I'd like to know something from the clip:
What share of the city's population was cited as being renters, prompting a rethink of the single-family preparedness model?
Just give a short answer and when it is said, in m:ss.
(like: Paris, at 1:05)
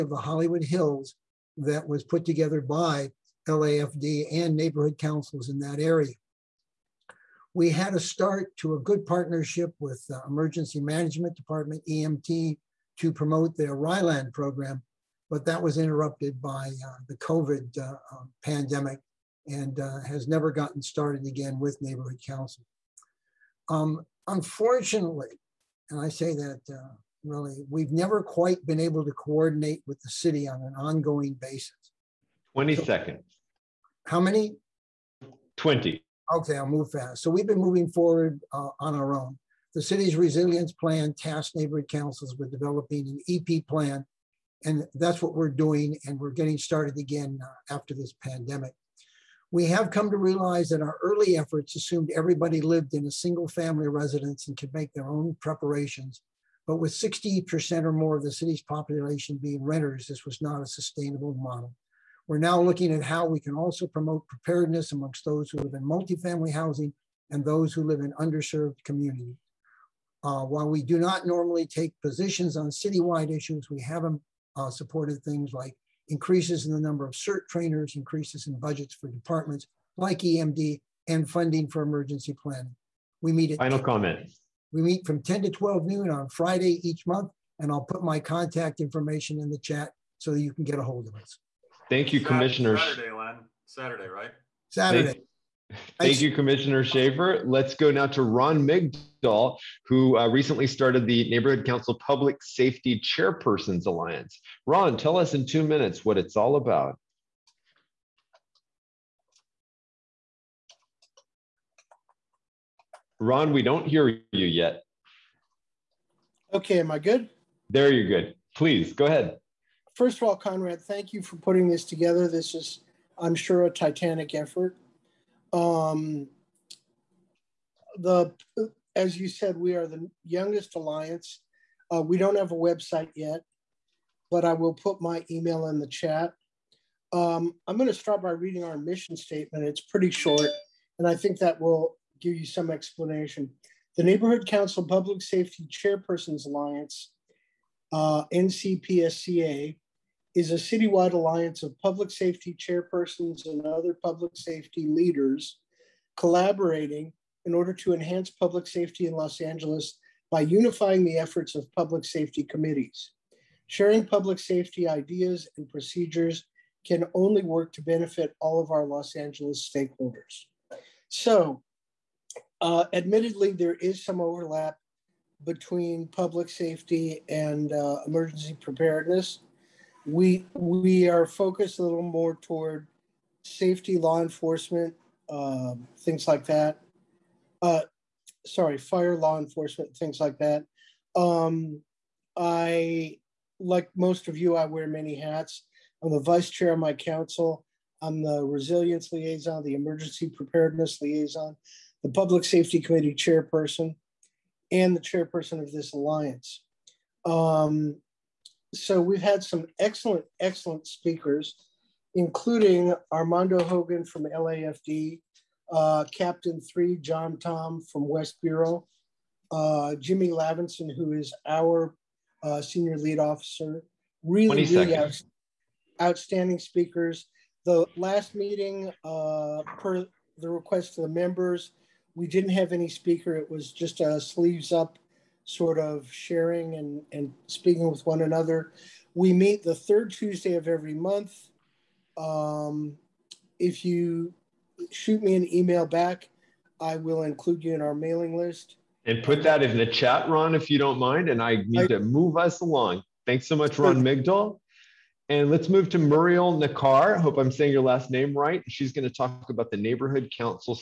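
60%, at 0:56.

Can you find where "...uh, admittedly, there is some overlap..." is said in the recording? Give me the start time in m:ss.
2:52.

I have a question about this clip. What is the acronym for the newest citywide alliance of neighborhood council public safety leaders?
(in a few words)
NCPSCA.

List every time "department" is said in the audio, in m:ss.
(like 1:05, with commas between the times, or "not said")
0:11, 1:19.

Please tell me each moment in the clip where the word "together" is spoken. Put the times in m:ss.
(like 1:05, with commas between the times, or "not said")
0:02, 2:01.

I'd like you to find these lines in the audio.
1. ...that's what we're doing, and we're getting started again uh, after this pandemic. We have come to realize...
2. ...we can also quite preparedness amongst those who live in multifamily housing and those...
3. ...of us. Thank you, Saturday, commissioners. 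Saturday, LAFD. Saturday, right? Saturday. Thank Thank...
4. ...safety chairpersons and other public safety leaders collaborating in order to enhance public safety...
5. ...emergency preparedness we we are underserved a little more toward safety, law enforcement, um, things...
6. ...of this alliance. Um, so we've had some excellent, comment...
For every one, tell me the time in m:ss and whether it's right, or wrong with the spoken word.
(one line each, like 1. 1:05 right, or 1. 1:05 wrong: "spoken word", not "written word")
1. 0:44 right
2. 1:03 wrong: "promote", not "quite"
3. 1:31 wrong: "Len", not "LAFD"
4. 2:32 right
5. 2:58 wrong: "focused", not "underserved"
6. 3:25 wrong: "excellent", not "comment".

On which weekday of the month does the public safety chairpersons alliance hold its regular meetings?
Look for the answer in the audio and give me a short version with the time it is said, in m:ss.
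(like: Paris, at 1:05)
third Tuesday, at 3:59.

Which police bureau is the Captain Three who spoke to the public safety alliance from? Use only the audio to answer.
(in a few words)
West Bureau.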